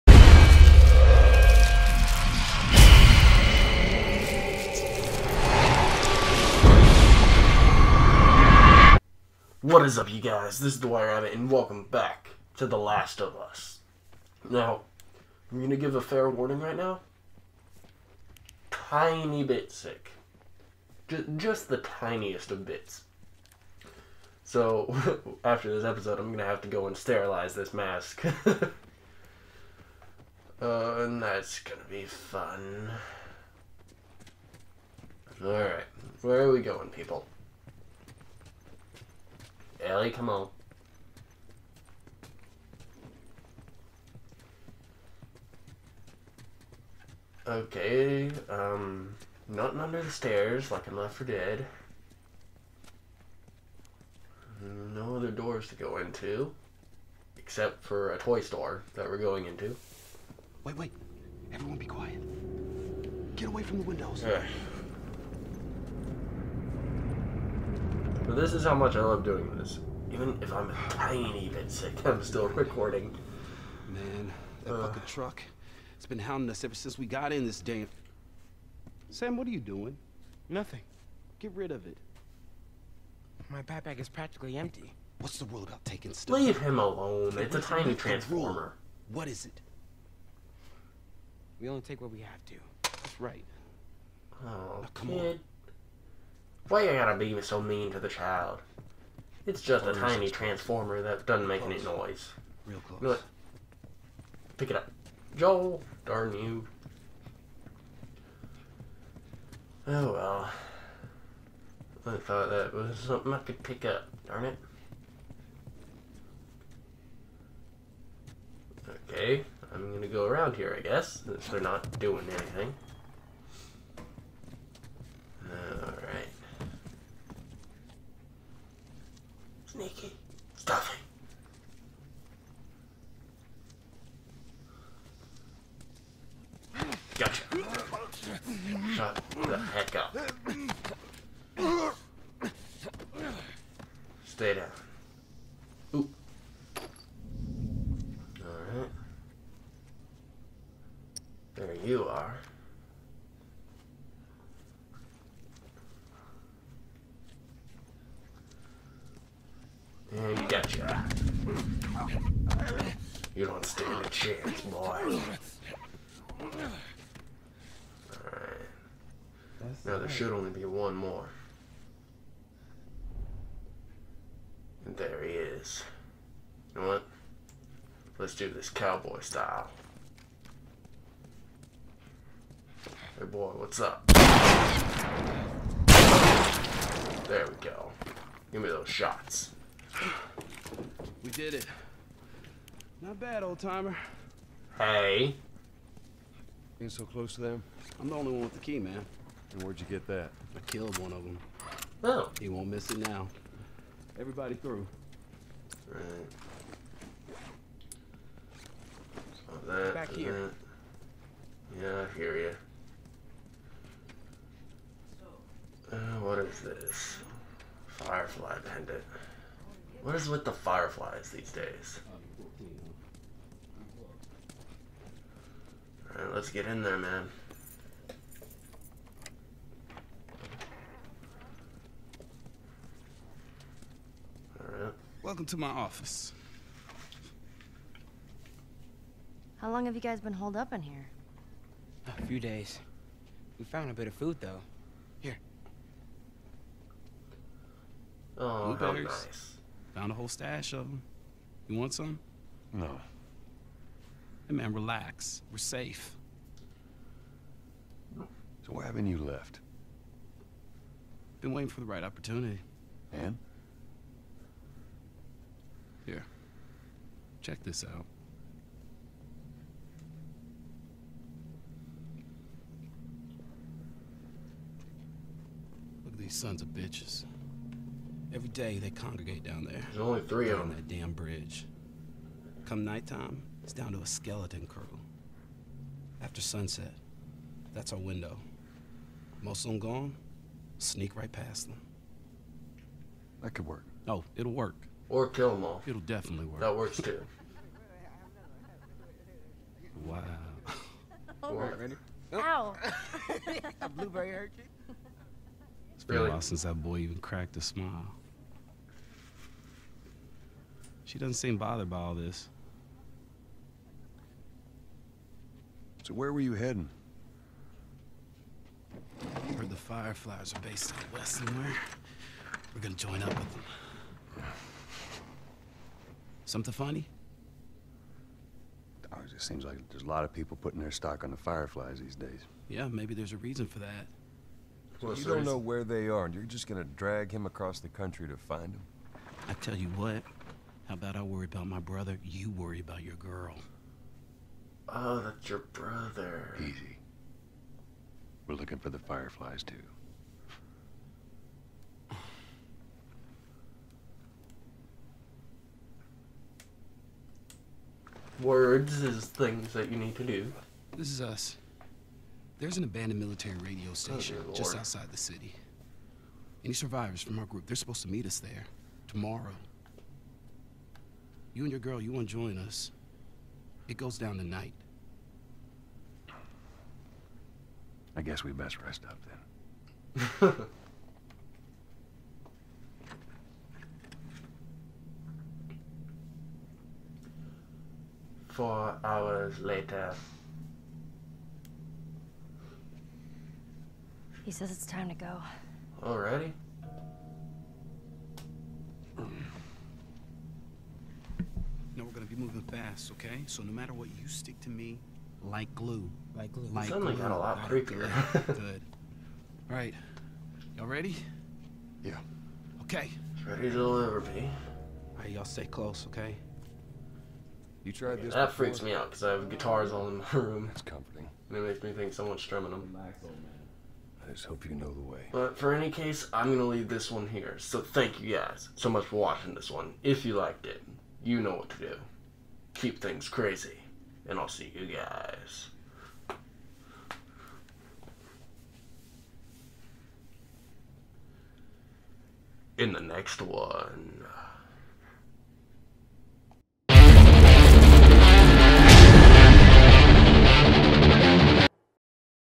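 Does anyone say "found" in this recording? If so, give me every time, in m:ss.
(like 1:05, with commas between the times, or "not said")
4:03, 4:09.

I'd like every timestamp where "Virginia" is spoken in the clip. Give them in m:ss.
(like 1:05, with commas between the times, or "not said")
not said.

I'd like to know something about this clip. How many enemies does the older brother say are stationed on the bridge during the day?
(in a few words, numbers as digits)
3.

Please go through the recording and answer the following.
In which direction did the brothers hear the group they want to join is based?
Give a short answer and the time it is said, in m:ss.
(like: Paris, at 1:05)
west, at 5:20.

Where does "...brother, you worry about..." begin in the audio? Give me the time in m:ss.
5:41.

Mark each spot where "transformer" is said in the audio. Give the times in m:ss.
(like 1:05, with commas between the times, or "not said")
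1:27, 1:40.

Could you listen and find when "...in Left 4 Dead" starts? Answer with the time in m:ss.
0:50.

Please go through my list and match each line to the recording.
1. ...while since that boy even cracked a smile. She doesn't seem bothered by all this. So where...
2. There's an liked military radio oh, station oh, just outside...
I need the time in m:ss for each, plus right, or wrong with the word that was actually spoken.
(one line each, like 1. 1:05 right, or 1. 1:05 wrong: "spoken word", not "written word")
1. 5:06 right
2. 6:02 wrong: "abandoned", not "liked".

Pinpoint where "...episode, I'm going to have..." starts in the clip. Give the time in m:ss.
0:25.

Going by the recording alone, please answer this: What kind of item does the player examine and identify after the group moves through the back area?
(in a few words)
Firefly pendant.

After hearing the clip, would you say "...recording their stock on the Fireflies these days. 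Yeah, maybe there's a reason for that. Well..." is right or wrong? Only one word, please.
wrong.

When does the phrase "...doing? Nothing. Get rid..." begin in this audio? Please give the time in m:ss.
1:19.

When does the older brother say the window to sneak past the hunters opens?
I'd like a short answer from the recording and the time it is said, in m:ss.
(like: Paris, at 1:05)
After sunset, at 4:46.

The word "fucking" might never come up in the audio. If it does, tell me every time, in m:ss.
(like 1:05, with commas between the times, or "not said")
1:14.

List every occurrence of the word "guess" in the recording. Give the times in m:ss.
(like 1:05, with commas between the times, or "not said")
2:00, 6:18.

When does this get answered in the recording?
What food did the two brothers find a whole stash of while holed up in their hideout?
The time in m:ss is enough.
4:08.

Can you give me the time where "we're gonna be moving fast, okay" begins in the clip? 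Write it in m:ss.
6:42.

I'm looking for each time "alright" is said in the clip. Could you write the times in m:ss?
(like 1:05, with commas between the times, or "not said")
0:35, 3:46, 3:54, 6:49.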